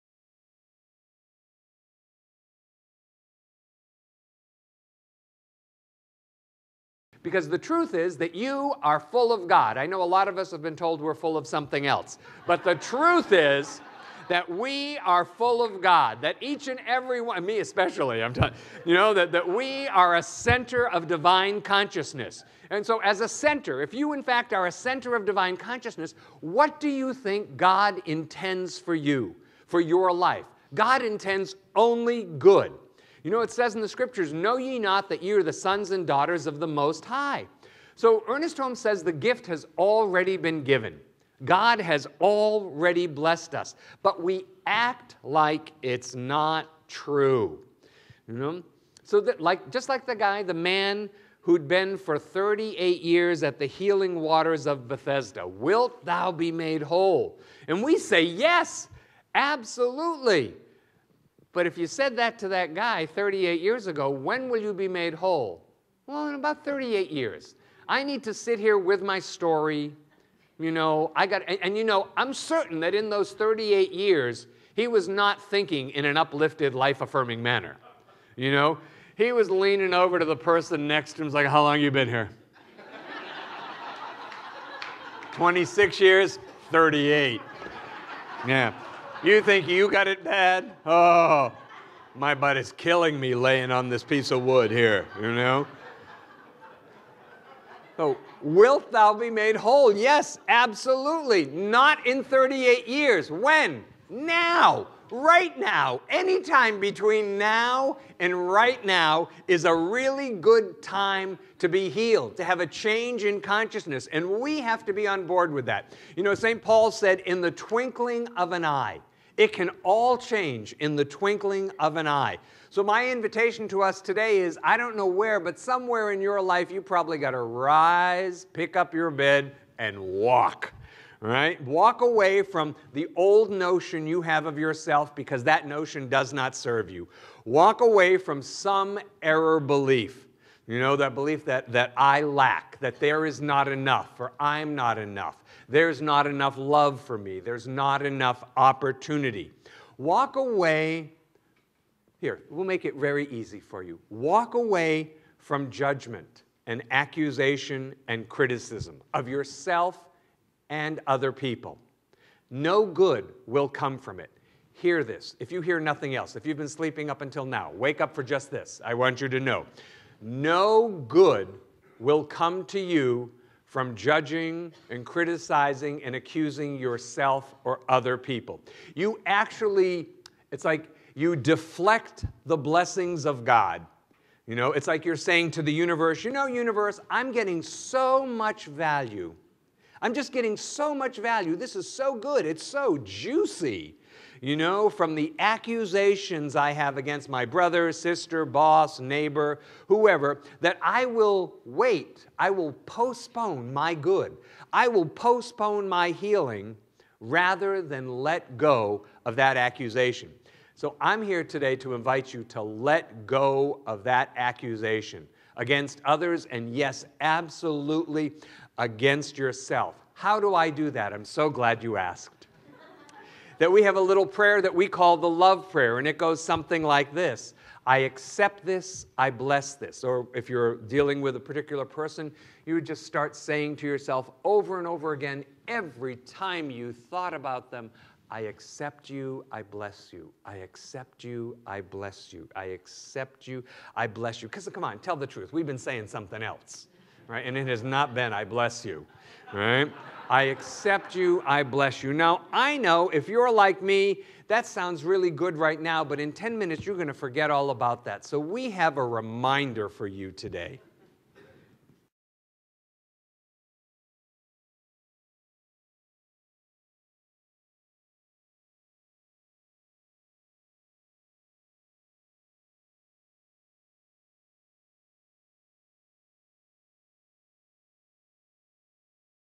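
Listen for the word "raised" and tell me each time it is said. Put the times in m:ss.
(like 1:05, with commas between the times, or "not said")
not said.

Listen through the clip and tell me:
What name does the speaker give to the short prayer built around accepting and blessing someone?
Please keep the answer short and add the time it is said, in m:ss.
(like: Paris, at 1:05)
the love prayer, at 3:45.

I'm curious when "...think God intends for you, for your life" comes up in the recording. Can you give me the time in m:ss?
0:27.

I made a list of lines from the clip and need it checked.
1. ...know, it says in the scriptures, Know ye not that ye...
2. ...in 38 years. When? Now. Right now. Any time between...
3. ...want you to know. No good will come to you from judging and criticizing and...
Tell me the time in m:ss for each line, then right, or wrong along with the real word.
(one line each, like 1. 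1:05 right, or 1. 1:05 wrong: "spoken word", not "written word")
1. 0:33 right
2. 1:42 right
3. 2:48 right.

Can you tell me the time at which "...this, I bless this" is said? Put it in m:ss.
3:48.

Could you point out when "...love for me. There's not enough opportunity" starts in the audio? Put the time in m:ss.
2:26.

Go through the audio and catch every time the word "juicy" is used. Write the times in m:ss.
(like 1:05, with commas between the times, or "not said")
3:13.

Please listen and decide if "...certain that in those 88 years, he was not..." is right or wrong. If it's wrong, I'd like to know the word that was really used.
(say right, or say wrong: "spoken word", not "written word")
wrong: "38", not "88".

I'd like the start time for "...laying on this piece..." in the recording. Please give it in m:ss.
1:33.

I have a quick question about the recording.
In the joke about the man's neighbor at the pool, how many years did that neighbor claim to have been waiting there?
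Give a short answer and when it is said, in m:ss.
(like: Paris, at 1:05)
26, at 1:25.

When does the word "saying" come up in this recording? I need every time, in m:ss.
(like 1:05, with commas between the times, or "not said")
3:05, 3:53, 4:05.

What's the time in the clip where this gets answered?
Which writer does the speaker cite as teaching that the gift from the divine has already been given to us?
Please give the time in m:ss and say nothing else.
0:38.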